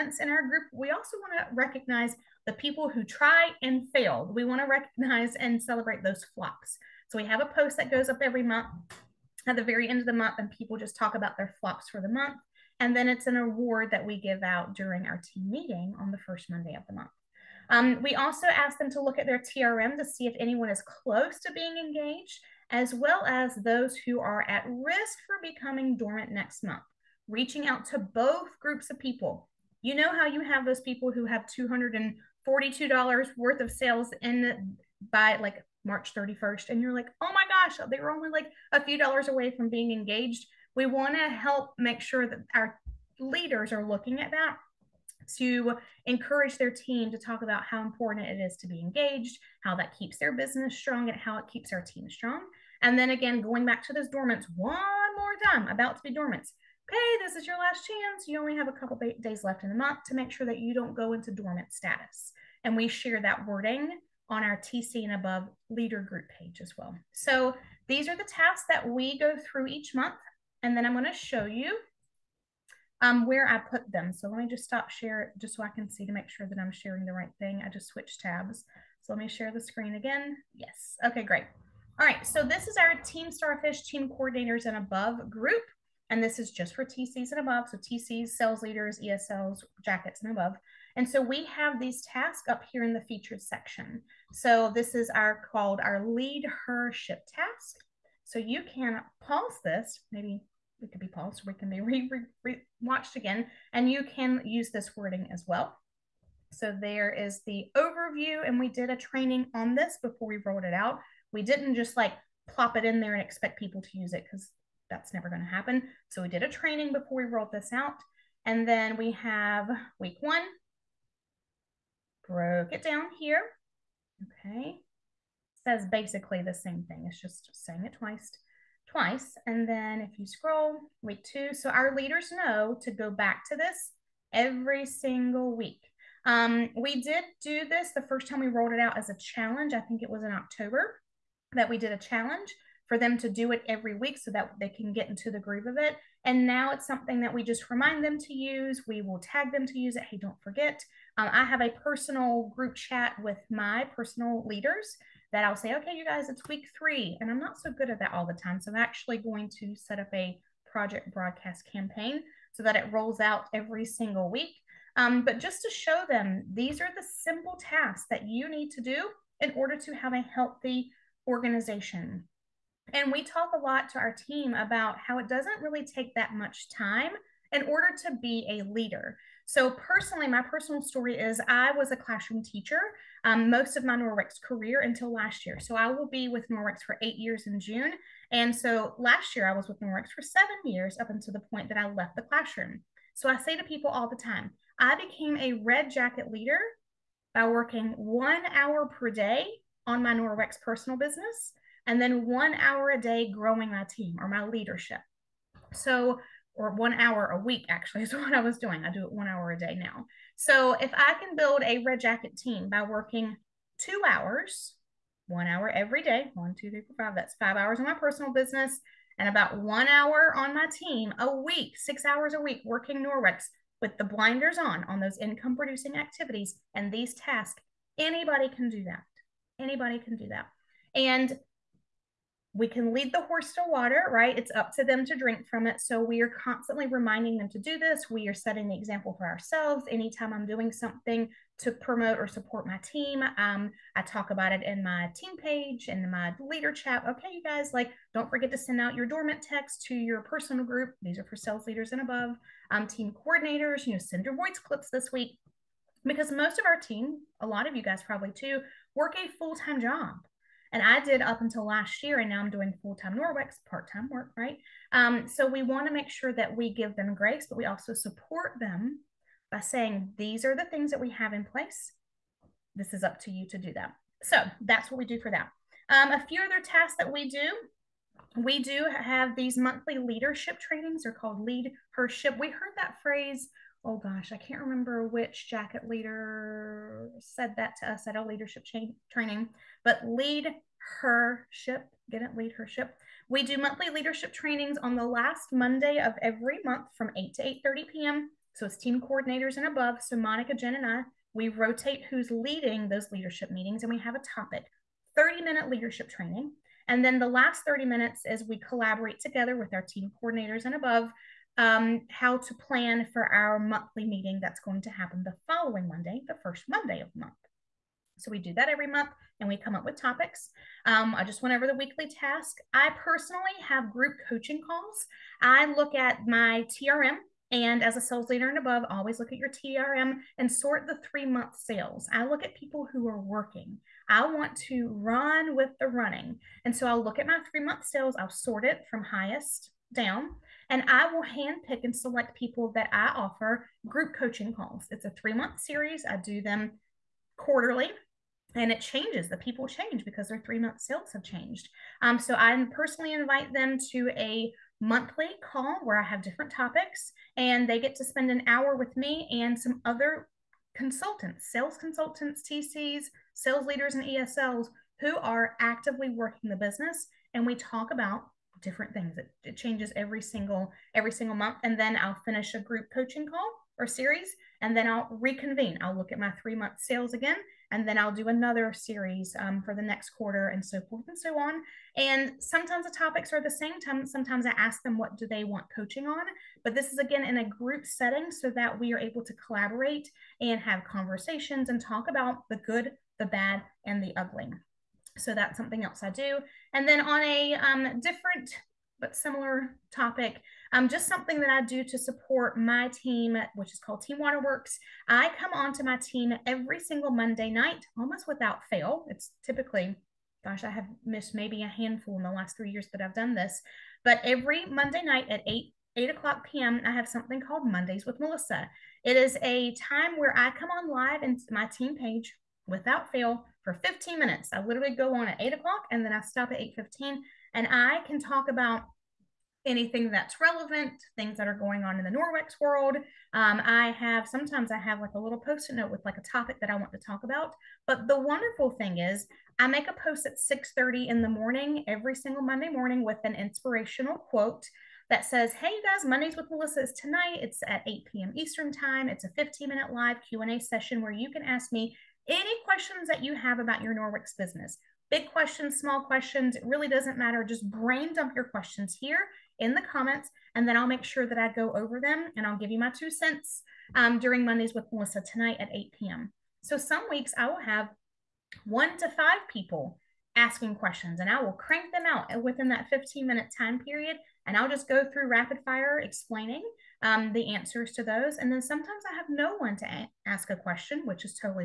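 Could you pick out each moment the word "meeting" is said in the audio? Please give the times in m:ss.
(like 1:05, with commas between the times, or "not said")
0:15, 5:03, 5:14.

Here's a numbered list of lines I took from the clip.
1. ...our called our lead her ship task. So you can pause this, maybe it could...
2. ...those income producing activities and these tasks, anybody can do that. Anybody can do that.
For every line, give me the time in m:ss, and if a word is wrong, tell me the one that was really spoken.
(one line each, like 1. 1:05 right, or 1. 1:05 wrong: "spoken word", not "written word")
1. 1:35 right
2. 3:44 right.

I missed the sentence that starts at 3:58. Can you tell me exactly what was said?
We are setting the example for ourselves.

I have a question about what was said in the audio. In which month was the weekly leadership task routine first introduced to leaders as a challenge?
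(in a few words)
October.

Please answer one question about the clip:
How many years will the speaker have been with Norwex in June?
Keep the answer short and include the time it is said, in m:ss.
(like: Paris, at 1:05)
8, at 3:07.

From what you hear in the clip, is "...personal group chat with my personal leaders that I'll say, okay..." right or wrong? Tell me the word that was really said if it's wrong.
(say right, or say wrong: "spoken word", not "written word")
right.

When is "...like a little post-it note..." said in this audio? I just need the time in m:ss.
7:14.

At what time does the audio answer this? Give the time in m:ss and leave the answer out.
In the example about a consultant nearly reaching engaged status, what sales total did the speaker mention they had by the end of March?
0:31.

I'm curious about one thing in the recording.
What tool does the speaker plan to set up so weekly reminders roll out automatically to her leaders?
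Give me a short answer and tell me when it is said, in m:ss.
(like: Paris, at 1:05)
Project Broadcast, at 2:40.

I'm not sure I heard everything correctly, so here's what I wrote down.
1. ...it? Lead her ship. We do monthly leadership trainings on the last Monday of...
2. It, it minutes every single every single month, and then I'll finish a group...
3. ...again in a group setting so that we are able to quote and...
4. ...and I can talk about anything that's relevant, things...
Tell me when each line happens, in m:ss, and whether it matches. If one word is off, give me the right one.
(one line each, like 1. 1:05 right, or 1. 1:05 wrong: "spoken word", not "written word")
1. 4:52 right
2. 6:09 wrong: "changes", not "minutes"
3. 6:26 wrong: "collaborate", not "quote"
4. 7:07 right.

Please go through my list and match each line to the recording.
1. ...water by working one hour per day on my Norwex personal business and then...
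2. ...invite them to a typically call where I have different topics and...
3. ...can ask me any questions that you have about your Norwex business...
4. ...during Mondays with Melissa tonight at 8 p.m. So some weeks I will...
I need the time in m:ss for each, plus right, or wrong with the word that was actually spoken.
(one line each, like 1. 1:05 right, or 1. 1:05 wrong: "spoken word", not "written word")
1. 3:16 wrong: "leader", not "water"
2. 5:53 wrong: "monthly", not "typically"
3. 7:31 right
4. 7:44 right.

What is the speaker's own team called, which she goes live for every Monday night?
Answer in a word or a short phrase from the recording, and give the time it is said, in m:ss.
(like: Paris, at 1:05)
Team Waterworks, at 6:44.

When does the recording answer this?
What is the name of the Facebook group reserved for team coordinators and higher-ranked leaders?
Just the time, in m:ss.
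1:23.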